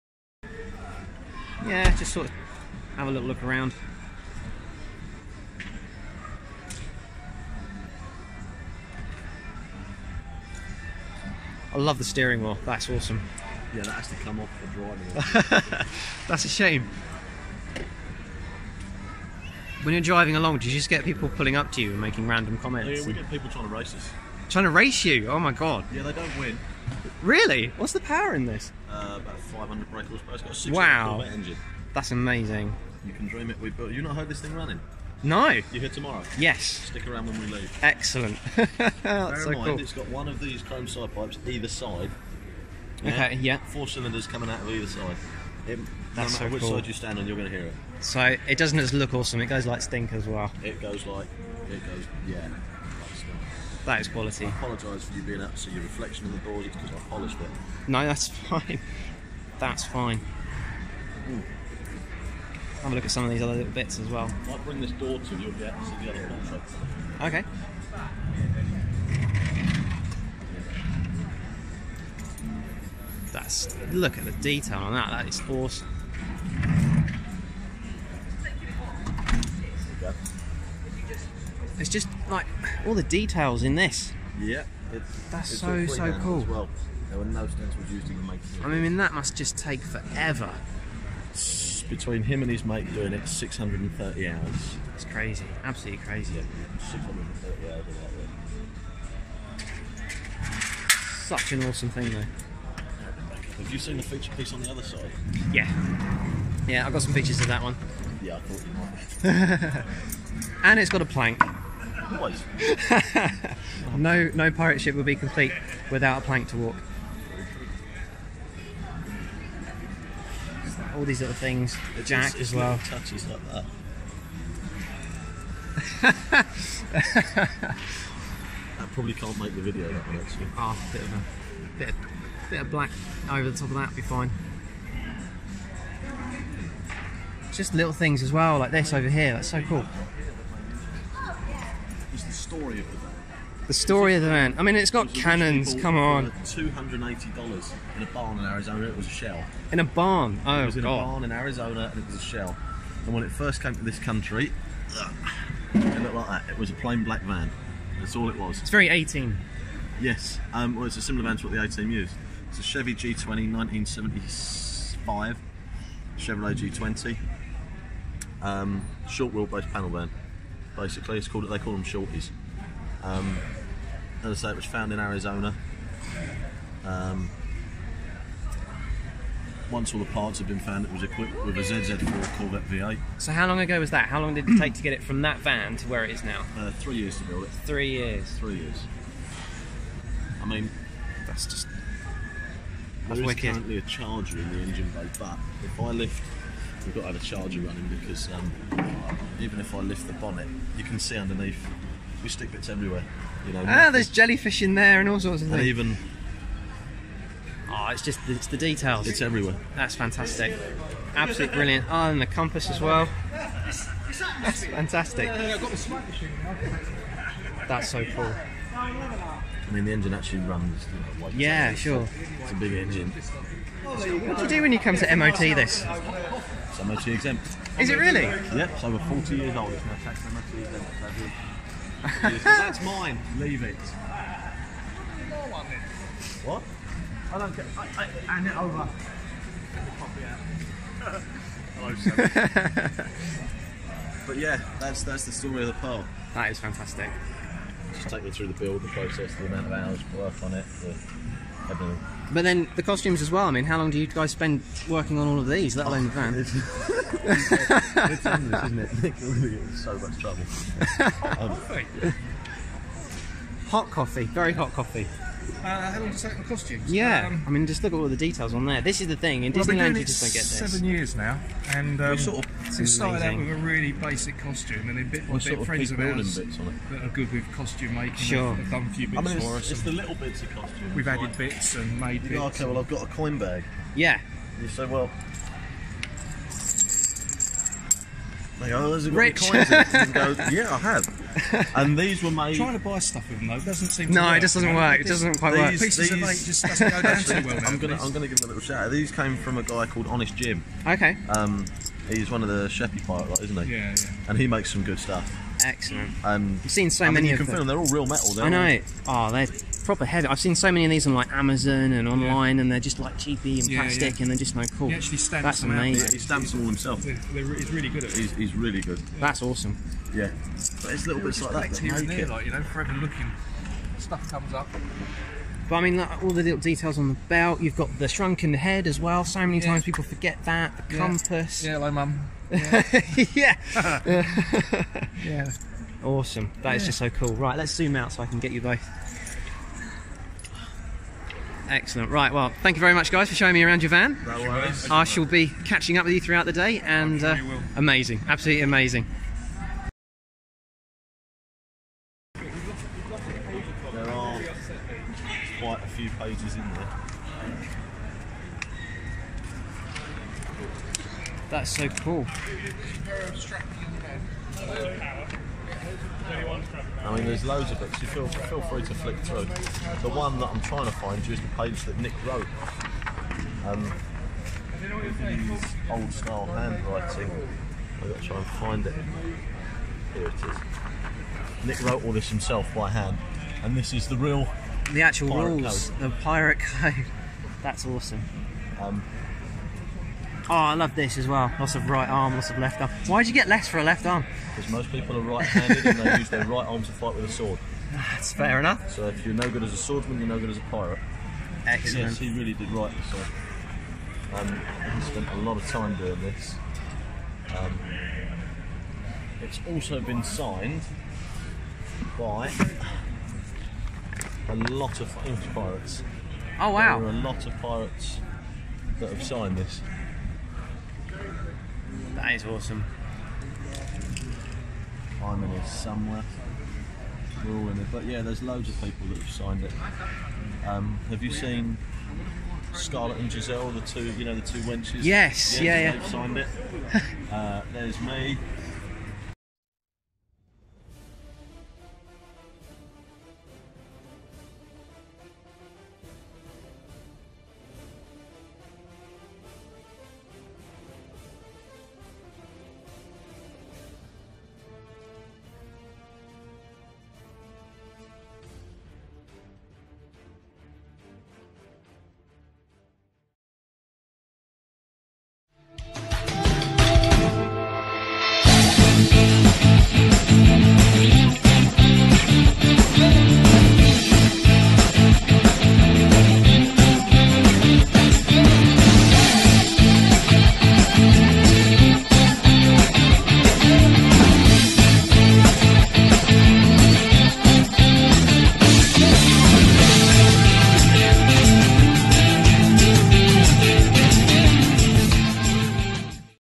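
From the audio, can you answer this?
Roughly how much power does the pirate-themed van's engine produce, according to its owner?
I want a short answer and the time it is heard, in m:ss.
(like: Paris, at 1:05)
500 brake horsepower, at 0:29.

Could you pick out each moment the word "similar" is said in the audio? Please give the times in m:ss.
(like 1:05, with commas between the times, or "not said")
2:41.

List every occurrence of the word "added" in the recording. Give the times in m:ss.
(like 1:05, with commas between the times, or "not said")
4:41.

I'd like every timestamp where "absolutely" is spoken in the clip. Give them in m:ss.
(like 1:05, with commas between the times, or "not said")
1:35, 3:31, 5:48.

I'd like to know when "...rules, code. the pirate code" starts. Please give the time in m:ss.
6:25.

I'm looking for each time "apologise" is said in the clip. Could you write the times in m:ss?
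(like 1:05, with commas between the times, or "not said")
0:54.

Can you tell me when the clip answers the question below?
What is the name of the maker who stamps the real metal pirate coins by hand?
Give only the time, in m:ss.
5:00.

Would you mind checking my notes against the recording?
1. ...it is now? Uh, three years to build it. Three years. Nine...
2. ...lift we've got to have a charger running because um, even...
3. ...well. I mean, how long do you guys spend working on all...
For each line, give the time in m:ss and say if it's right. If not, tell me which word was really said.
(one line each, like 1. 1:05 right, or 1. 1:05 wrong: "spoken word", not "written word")
1. 3:06 wrong: "Three", not "Nine"
2. 3:15 right
3. 4:13 right.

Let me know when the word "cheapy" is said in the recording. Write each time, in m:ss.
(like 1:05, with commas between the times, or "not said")
5:13.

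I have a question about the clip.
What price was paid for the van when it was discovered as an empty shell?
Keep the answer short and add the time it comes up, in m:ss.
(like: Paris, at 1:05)
$280, at 2:26.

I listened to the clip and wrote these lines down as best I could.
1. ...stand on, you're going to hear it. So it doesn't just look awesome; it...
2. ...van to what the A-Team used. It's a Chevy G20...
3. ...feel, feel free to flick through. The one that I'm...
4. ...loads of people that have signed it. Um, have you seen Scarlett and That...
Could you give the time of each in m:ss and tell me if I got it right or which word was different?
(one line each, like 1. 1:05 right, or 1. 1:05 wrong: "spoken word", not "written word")
1. 0:46 right
2. 2:41 right
3. 6:08 right
4. 7:08 wrong: "Giselle", not "That".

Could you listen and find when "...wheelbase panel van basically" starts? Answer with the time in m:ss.
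2:49.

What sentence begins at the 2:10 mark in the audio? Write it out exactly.
Ah, bit of a bit of, bit of black over the top of that be fine.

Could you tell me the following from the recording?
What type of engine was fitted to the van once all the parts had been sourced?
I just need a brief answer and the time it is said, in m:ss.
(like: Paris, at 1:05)
ZZ4 Corvette V8, at 3:01.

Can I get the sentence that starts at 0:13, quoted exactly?
Yeah, that has to come off the driving.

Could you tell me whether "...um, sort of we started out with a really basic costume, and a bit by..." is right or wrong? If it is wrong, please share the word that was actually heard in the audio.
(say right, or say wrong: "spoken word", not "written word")
right.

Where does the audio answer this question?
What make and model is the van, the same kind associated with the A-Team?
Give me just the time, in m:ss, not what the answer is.
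2:46.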